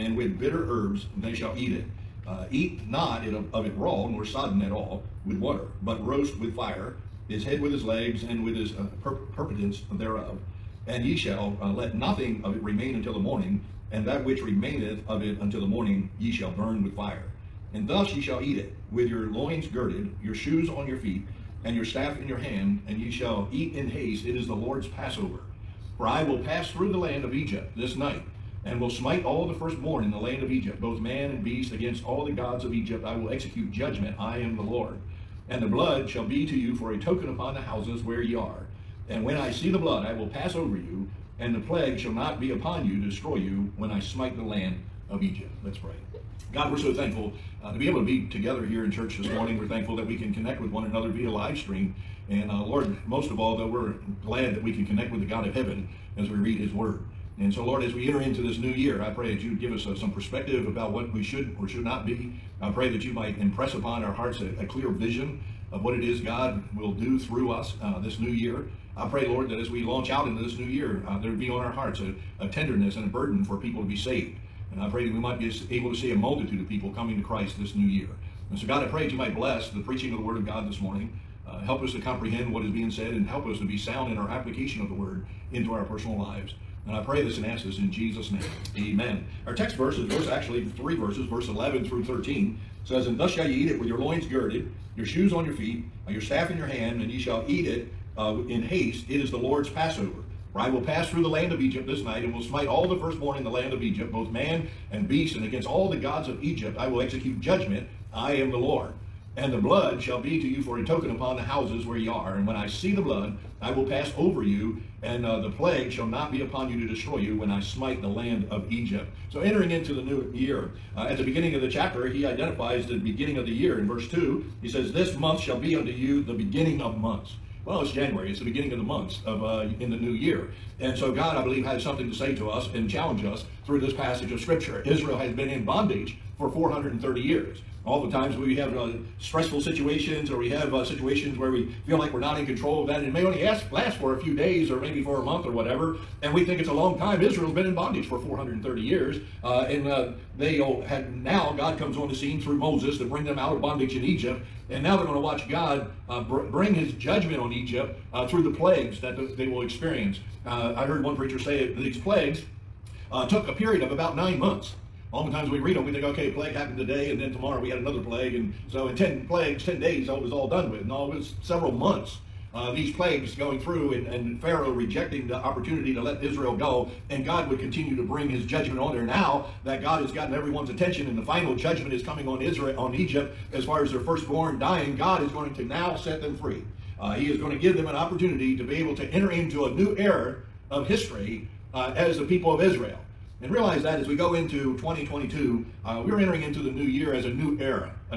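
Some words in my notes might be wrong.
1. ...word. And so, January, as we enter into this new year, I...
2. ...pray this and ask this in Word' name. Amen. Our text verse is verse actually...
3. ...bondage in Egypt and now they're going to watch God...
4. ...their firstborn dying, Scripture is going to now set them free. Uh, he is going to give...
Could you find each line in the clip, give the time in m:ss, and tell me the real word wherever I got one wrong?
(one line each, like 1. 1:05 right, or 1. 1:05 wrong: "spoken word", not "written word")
1. 0:56 wrong: "Lord", not "January"
2. 1:27 wrong: "Jesus", not "Word"
3. 2:33 right
4. 3:03 wrong: "God", not "Scripture".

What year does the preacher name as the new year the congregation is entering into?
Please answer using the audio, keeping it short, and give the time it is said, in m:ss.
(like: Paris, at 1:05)
2022, at 3:14.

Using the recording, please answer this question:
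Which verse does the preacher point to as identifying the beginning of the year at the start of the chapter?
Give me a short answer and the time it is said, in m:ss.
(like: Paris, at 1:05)
verse 2, at 2:03.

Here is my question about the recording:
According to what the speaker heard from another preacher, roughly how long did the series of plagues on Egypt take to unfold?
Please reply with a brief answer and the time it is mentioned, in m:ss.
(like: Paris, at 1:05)
about 9 months, at 2:43.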